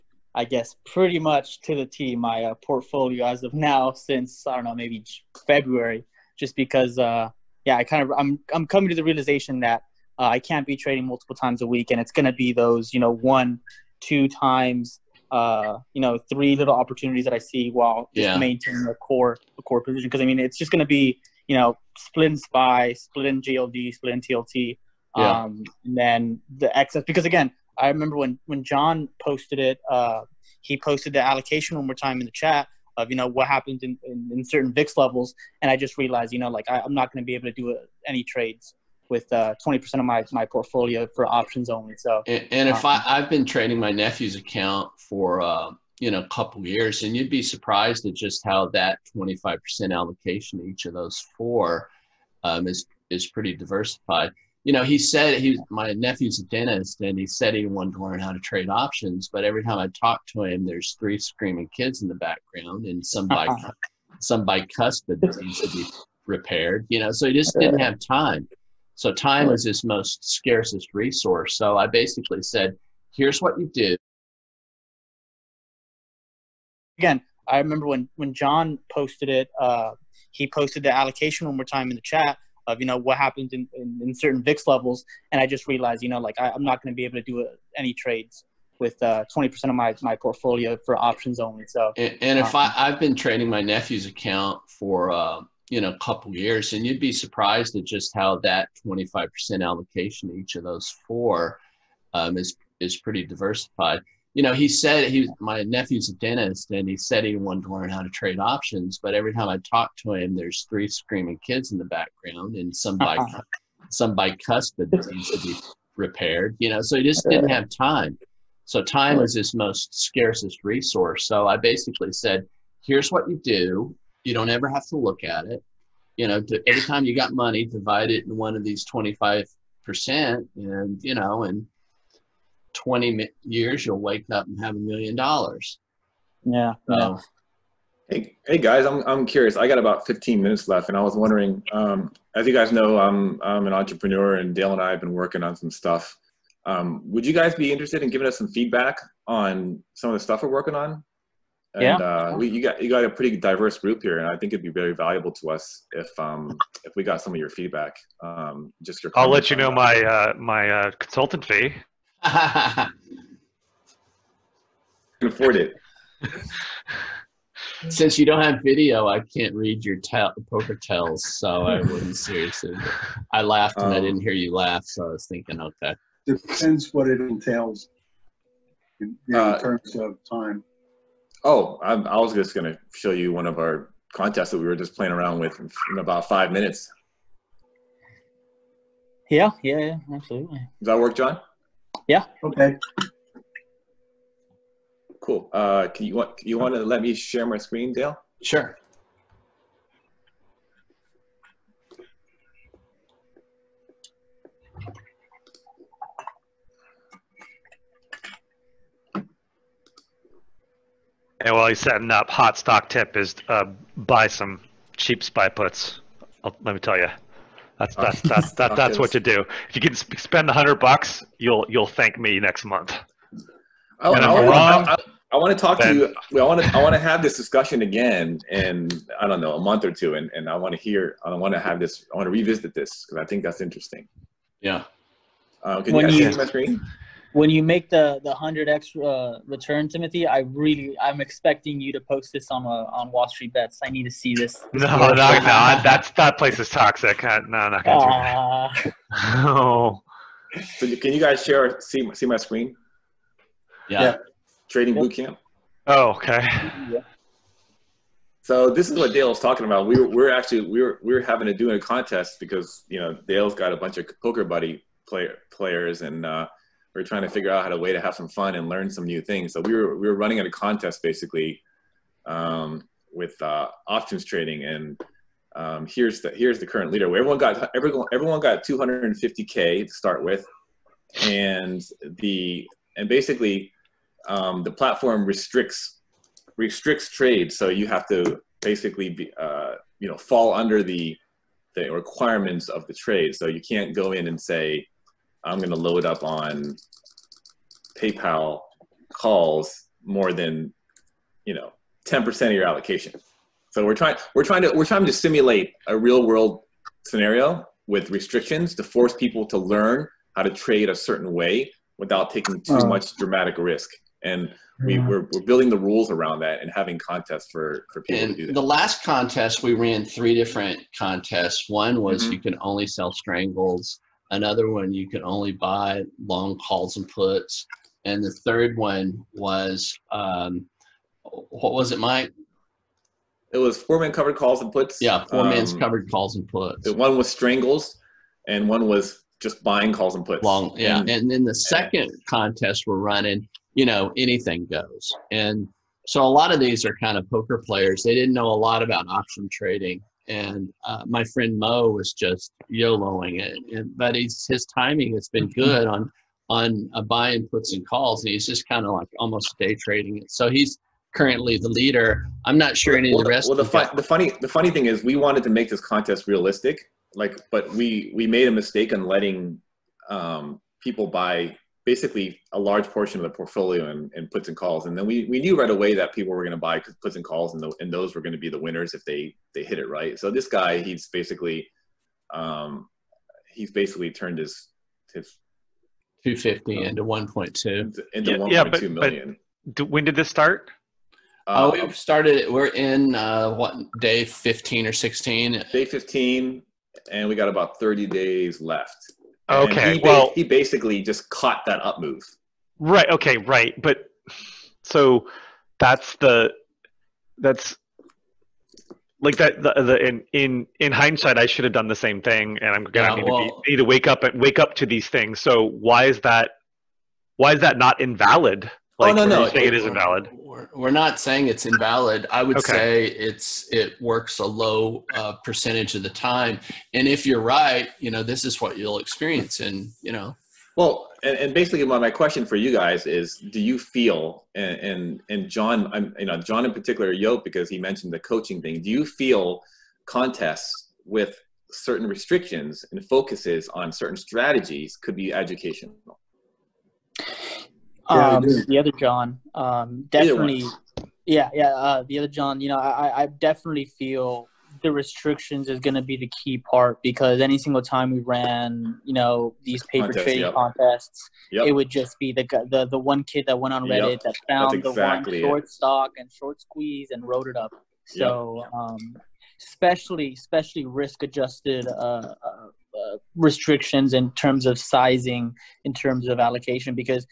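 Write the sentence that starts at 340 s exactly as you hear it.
And, and then the second contest we're running, you know, anything goes.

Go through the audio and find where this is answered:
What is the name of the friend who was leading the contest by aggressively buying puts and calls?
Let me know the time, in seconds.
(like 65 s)
351 s.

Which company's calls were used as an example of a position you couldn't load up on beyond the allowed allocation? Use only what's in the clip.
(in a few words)
PayPal.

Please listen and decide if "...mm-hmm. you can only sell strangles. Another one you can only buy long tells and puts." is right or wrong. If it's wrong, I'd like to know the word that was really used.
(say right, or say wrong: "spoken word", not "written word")
wrong: "calls", not "tells".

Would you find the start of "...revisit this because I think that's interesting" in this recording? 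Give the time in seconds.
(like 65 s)
232 s.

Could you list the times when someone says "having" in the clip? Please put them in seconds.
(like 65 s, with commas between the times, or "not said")
261 s, 316 s.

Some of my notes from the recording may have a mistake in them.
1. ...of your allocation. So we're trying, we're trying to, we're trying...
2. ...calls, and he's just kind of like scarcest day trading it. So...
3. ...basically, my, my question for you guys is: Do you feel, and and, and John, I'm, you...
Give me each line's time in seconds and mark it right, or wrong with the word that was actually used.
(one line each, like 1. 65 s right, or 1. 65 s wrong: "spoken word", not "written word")
1. 302 s right
2. 357 s wrong: "almost", not "scarcest"
3. 431 s right.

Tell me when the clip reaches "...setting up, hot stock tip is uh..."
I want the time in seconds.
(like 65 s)
211 s.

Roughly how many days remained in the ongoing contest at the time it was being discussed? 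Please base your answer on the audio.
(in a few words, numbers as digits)
30.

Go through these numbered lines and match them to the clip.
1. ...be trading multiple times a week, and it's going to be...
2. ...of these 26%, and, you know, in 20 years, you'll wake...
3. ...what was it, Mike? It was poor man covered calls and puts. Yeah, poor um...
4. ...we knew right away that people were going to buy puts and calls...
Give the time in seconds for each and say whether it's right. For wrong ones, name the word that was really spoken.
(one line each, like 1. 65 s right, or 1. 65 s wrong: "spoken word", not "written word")
1. 10 s right
2. 128 s wrong: "25", not "26"
3. 331 s right
4. 375 s right.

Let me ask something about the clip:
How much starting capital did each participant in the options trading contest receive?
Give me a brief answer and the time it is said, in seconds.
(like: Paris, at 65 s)
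250k, at 278 s.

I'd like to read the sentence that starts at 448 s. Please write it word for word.
Um, the other John, um, definitely.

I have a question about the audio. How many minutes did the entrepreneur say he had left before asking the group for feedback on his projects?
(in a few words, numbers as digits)
15.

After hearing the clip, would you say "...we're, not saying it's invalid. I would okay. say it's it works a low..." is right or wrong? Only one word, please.
right.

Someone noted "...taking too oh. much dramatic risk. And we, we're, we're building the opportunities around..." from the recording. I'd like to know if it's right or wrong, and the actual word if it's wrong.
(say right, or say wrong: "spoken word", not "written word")
wrong: "rules", not "opportunities".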